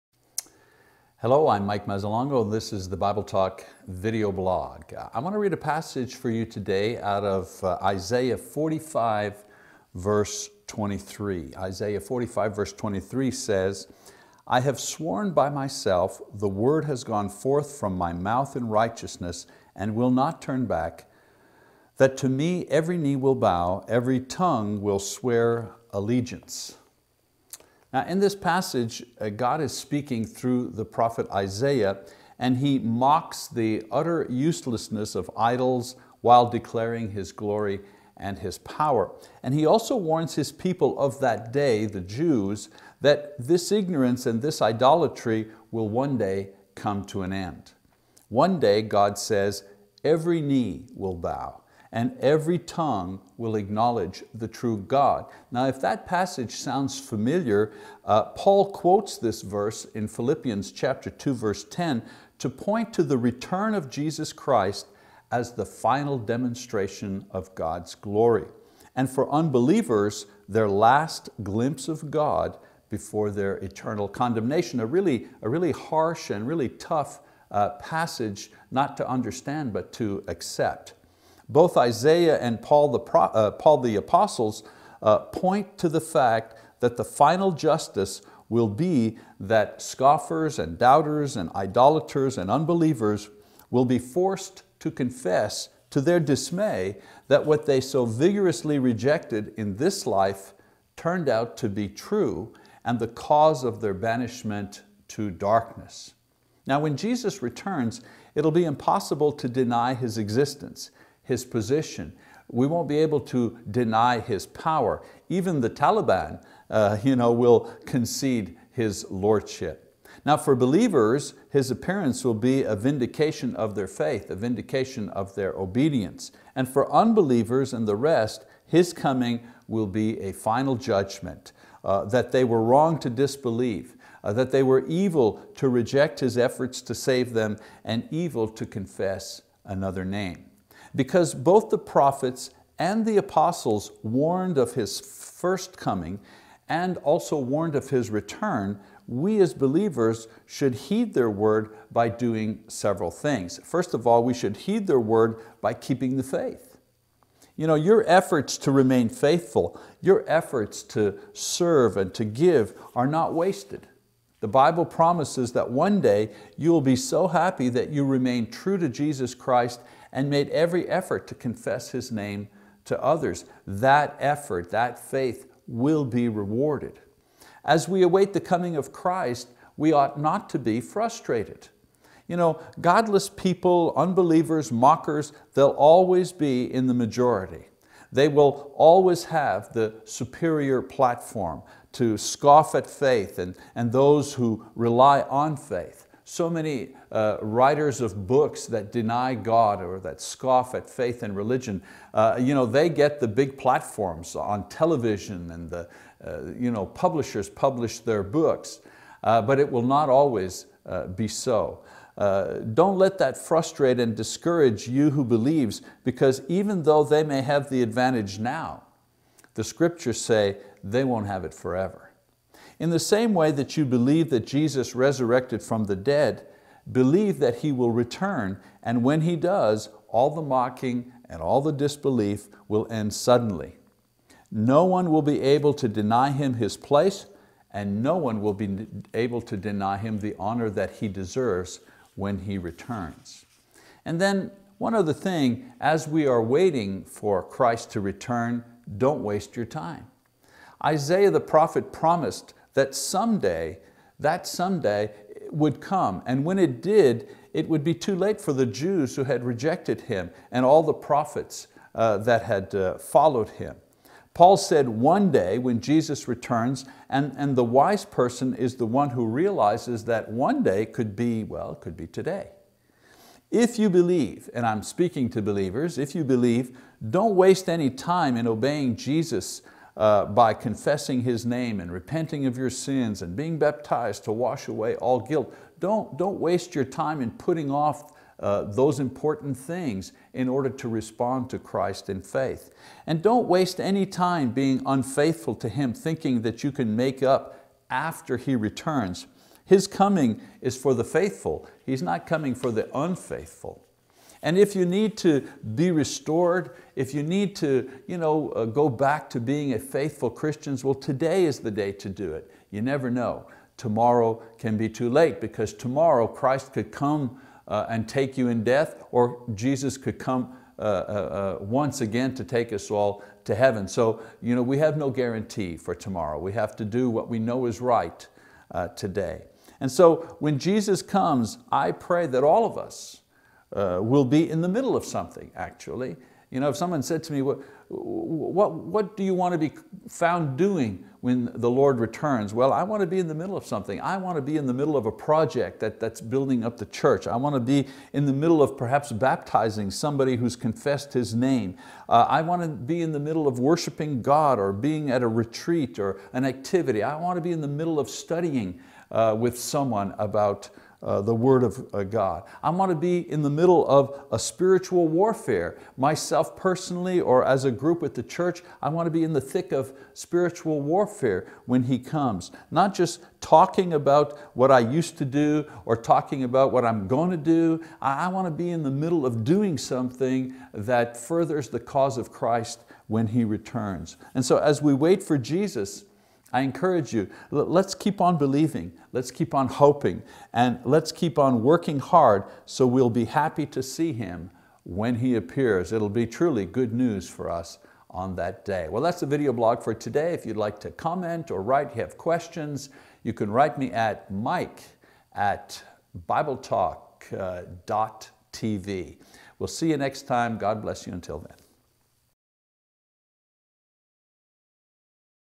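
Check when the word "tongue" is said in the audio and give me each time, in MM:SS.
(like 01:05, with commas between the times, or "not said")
00:24, 00:52.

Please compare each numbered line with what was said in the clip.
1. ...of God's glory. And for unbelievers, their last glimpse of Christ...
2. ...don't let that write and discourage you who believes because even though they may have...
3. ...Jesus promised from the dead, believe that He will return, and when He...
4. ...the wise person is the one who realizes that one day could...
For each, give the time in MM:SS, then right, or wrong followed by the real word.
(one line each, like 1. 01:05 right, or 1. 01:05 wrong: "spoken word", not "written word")
1. 01:07 wrong: "God", not "Christ"
2. 03:32 wrong: "frustrate", not "write"
3. 03:44 wrong: "resurrected", not "promised"
4. 04:27 right.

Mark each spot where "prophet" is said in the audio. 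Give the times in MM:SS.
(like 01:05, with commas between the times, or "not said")
00:30, 02:21, 04:11, 04:20.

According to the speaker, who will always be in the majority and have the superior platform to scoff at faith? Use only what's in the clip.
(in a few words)
godless people.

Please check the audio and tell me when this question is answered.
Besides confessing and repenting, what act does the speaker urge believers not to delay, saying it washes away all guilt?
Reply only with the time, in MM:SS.
04:43.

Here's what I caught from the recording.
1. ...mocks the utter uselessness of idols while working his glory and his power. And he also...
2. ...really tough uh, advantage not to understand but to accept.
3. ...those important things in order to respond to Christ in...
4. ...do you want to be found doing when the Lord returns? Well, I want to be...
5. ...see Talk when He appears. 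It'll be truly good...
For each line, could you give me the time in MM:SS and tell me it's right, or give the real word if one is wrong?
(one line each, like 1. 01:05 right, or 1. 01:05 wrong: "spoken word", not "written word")
1. 00:32 wrong: "declaring", not "working"
2. 01:16 wrong: "passage", not "advantage"
3. 04:48 right
4. 05:39 right
5. 06:33 wrong: "Him", not "Talk".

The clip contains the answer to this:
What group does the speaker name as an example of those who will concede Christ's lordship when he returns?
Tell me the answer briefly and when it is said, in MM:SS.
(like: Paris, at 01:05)
the Taliban, at 01:55.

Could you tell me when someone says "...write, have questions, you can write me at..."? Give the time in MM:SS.
06:41.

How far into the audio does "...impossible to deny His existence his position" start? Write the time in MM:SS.
01:48.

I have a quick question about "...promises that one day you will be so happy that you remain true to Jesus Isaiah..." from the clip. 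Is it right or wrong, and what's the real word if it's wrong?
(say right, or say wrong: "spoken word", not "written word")
wrong: "Christ", not "Isaiah".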